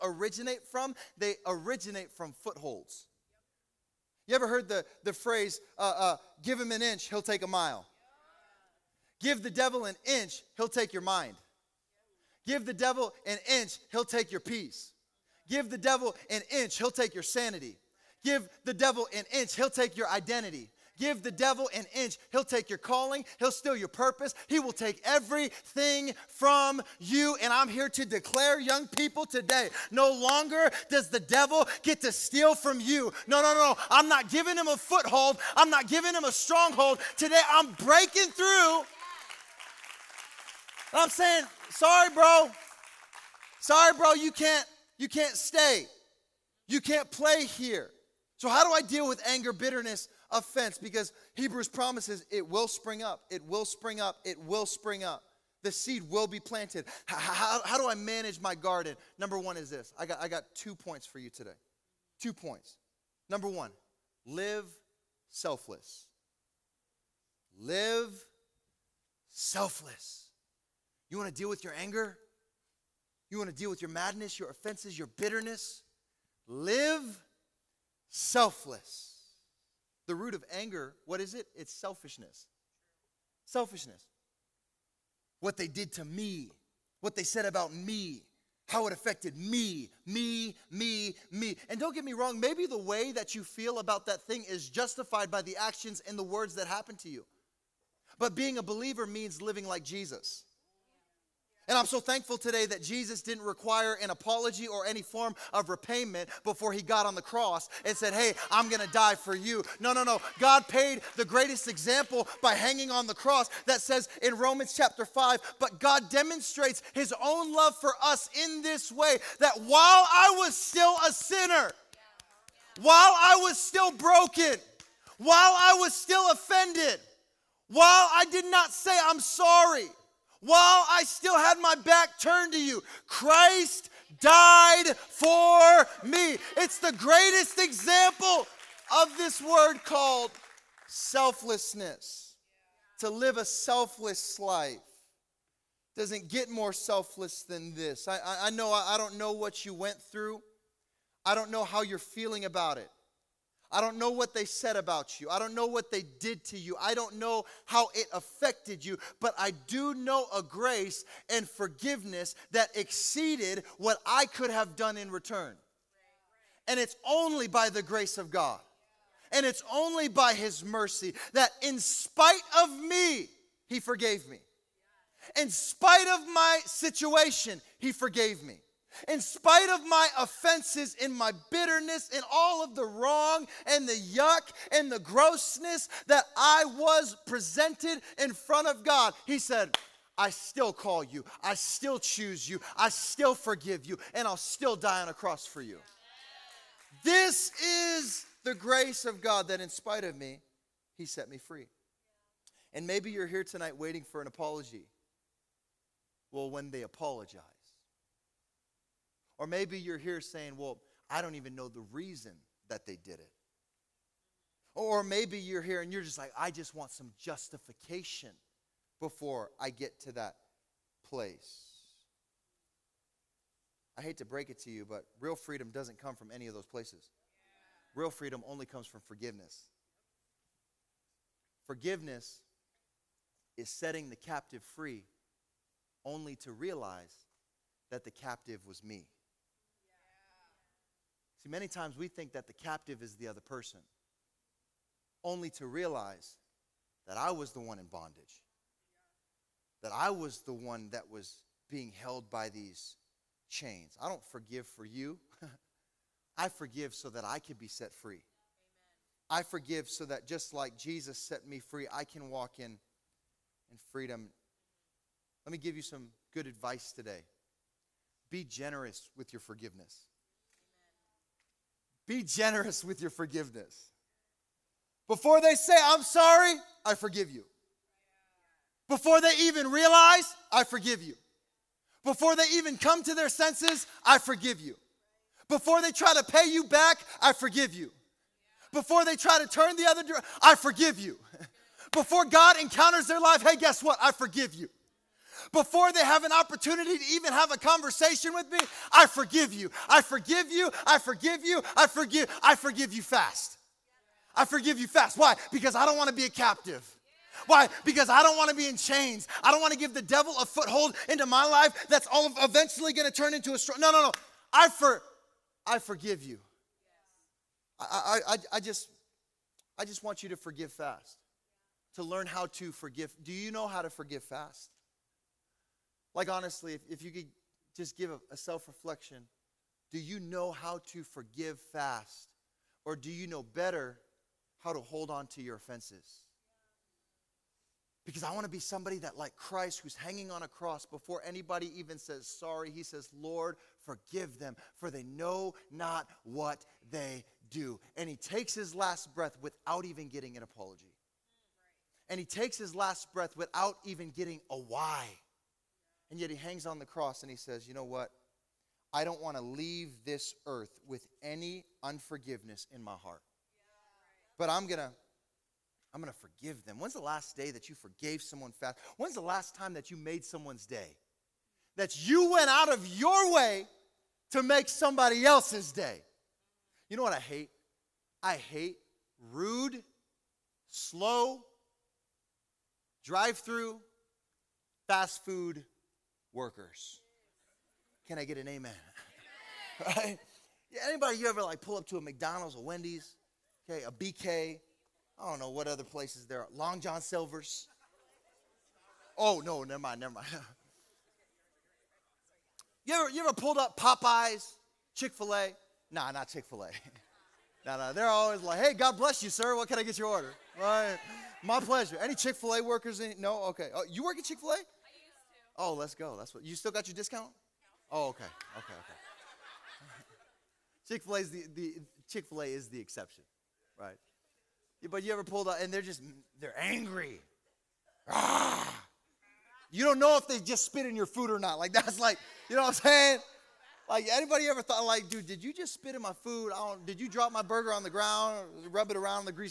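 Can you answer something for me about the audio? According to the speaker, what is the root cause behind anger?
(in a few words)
Selfishness.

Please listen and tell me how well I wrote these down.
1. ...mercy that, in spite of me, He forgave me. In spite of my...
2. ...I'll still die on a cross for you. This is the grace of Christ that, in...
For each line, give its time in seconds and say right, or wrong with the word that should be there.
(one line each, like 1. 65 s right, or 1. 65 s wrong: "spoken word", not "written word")
1. 170 s right
2. 194 s wrong: "God", not "Christ".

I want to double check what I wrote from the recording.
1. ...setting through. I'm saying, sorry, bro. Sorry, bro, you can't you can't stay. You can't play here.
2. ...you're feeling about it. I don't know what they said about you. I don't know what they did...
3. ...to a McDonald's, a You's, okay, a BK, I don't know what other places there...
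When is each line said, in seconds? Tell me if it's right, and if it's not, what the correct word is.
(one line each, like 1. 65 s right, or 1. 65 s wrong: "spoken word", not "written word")
1. 37 s wrong: "breaking", not "setting"
2. 151 s right
3. 391 s wrong: "Wendy", not "You".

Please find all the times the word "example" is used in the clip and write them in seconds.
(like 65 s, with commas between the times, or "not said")
111 s, 137 s.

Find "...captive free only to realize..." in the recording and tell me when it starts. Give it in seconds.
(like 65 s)
234 s.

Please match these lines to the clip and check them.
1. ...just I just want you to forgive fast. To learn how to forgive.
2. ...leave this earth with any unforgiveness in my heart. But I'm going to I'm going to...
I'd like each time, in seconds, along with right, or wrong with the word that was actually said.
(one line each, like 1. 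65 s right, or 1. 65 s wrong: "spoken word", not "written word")
1. 318 s right
2. 359 s right.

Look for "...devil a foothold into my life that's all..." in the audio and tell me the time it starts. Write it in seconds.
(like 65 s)
310 s.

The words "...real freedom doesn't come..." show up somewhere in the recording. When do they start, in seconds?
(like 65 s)
225 s.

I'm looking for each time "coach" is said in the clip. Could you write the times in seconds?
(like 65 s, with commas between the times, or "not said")
not said.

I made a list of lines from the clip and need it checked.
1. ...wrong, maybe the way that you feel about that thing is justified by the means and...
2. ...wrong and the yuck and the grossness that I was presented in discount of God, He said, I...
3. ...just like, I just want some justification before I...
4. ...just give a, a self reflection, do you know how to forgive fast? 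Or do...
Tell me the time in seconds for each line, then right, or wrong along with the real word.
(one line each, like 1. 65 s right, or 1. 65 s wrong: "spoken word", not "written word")
1. 92 s wrong: "actions", not "means"
2. 182 s wrong: "front", not "discount"
3. 216 s right
4. 327 s right.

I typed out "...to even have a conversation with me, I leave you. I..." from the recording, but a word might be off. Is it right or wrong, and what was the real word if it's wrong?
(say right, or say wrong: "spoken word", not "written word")
wrong: "forgive", not "leave".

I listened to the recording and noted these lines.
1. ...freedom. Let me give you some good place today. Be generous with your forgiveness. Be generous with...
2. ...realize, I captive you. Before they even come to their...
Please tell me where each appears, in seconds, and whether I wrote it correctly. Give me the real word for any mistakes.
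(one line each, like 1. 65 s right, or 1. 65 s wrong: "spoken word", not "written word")
1. 263 s wrong: "advice", not "place"
2. 279 s wrong: "forgive", not "captive".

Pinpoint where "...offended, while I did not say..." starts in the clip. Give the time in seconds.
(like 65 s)
126 s.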